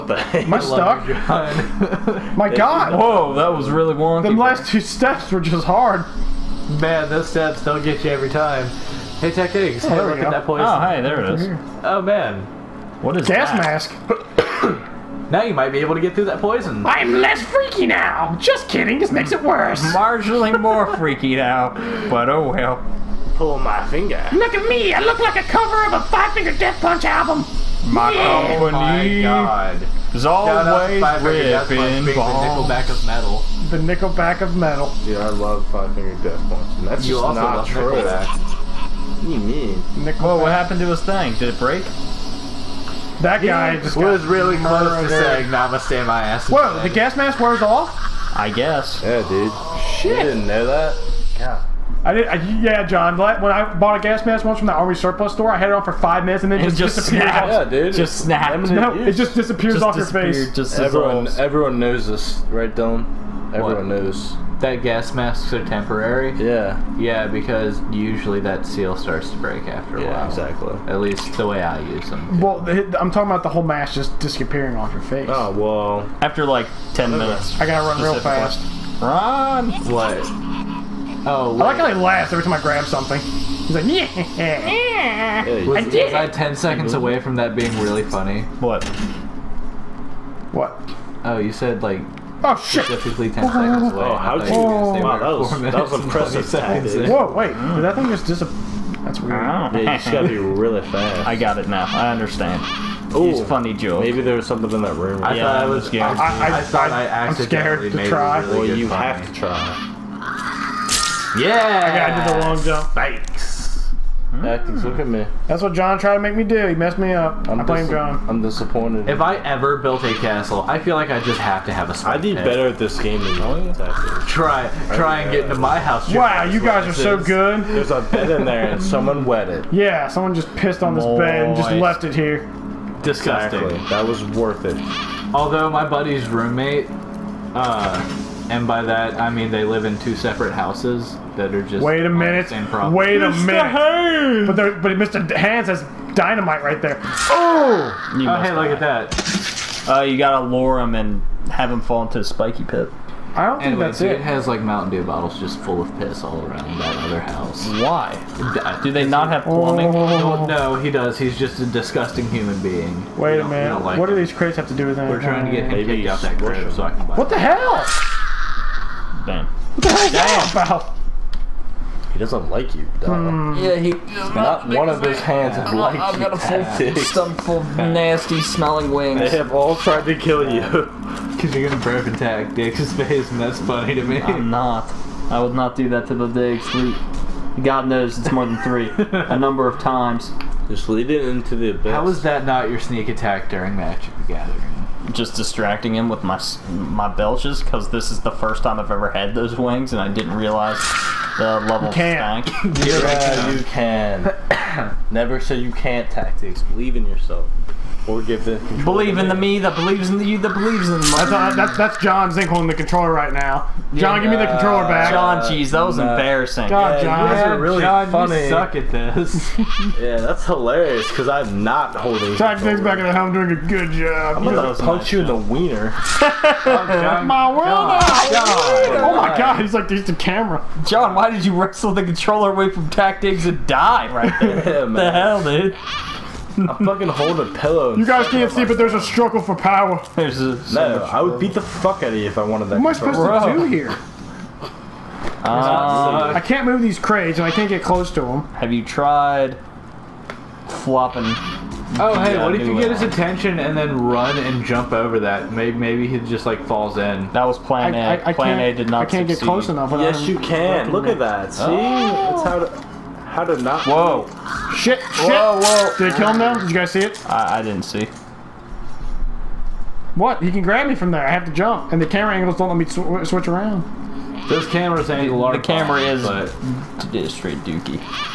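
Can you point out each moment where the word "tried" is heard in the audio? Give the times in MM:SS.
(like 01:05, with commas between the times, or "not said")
01:55, 02:59, 04:08.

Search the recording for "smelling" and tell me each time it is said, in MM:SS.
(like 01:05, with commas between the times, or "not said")
02:58.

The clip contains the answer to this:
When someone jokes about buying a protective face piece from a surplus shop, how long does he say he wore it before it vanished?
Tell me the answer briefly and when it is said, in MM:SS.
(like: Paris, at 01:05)
5 minutes, at 00:55.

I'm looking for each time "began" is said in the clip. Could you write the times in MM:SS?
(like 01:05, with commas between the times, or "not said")
not said.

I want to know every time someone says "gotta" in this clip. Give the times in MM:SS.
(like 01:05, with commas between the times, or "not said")
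01:17, 01:40, 02:30.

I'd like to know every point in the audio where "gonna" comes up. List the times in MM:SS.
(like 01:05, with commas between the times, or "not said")
03:01, 03:44.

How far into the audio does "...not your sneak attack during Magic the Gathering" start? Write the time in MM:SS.
03:12.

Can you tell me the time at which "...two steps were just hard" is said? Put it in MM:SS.
00:04.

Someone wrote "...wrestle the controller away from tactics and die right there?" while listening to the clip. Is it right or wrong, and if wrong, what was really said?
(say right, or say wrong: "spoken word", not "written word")
right.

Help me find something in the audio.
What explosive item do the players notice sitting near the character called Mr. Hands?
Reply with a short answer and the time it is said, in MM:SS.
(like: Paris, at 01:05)
dynamite, at 02:26.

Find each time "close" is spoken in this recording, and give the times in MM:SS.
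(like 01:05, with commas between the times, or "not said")
00:44, 04:07, 04:19.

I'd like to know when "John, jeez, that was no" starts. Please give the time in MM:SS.
03:35.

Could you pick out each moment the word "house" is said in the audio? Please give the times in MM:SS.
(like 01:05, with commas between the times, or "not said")
02:05, 02:20, 02:37.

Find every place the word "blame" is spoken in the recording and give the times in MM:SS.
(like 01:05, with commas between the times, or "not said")
01:57.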